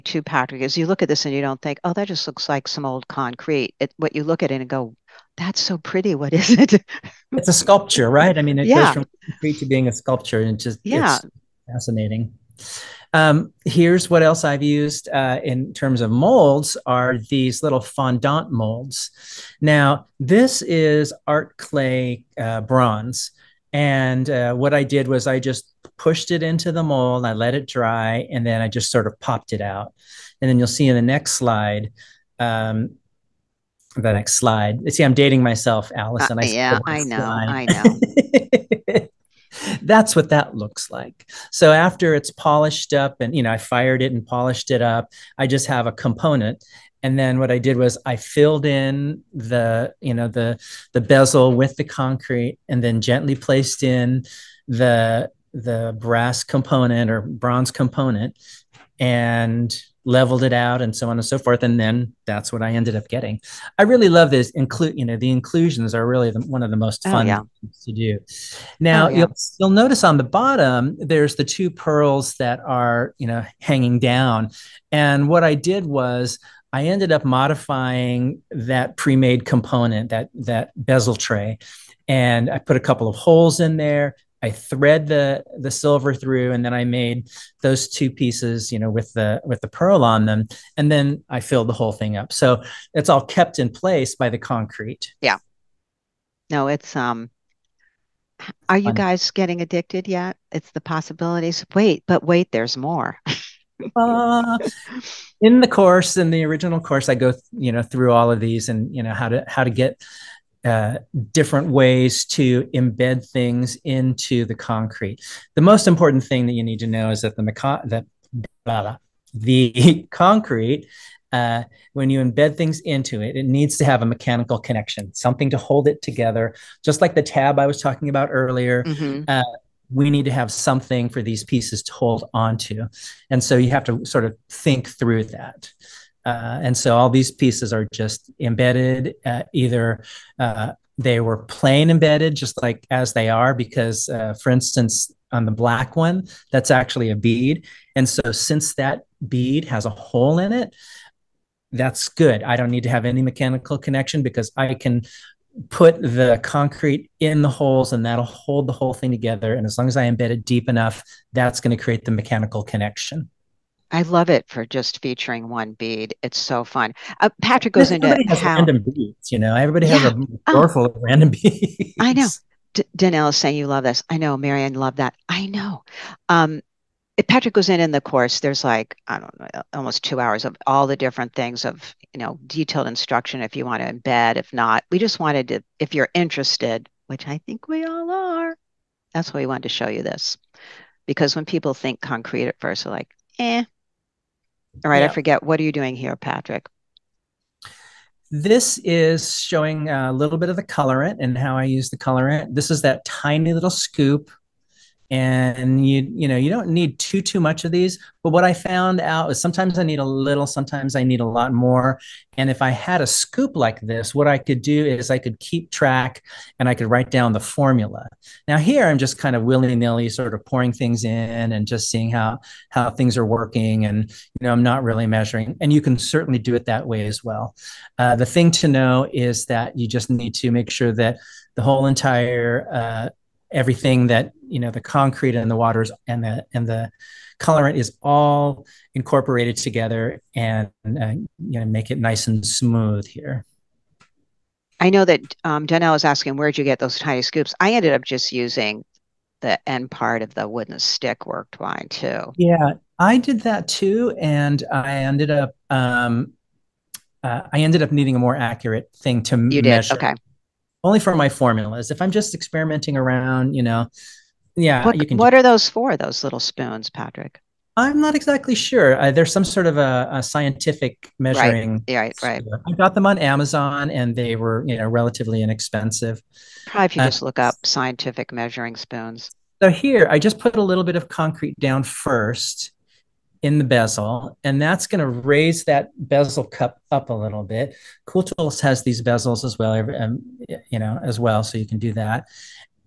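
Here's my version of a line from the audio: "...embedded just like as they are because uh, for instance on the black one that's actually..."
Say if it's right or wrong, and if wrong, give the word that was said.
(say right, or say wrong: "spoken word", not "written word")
right.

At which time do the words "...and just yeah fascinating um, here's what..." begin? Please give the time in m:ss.
0:10.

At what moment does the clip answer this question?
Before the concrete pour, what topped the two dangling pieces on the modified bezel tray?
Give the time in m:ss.
1:11.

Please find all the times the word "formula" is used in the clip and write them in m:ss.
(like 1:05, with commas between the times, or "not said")
3:37, 4:21.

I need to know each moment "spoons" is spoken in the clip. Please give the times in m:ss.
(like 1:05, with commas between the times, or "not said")
4:26, 4:38.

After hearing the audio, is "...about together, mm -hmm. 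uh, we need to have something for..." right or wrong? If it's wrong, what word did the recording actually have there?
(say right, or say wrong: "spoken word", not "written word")
wrong: "earlier", not "together".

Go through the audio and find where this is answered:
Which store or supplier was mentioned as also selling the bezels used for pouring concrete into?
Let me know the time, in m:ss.
4:48.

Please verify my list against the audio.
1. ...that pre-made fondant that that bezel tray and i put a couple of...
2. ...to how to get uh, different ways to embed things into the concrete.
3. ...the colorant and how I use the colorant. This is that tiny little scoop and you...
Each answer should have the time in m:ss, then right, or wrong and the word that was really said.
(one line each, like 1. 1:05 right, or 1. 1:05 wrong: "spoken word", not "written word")
1. 1:18 wrong: "component", not "fondant"
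2. 1:49 right
3. 3:20 right.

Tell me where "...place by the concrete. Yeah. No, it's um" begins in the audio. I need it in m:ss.
1:33.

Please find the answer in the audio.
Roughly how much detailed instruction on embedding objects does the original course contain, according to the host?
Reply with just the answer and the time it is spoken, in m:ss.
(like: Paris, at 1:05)
Almost two hours, at 2:59.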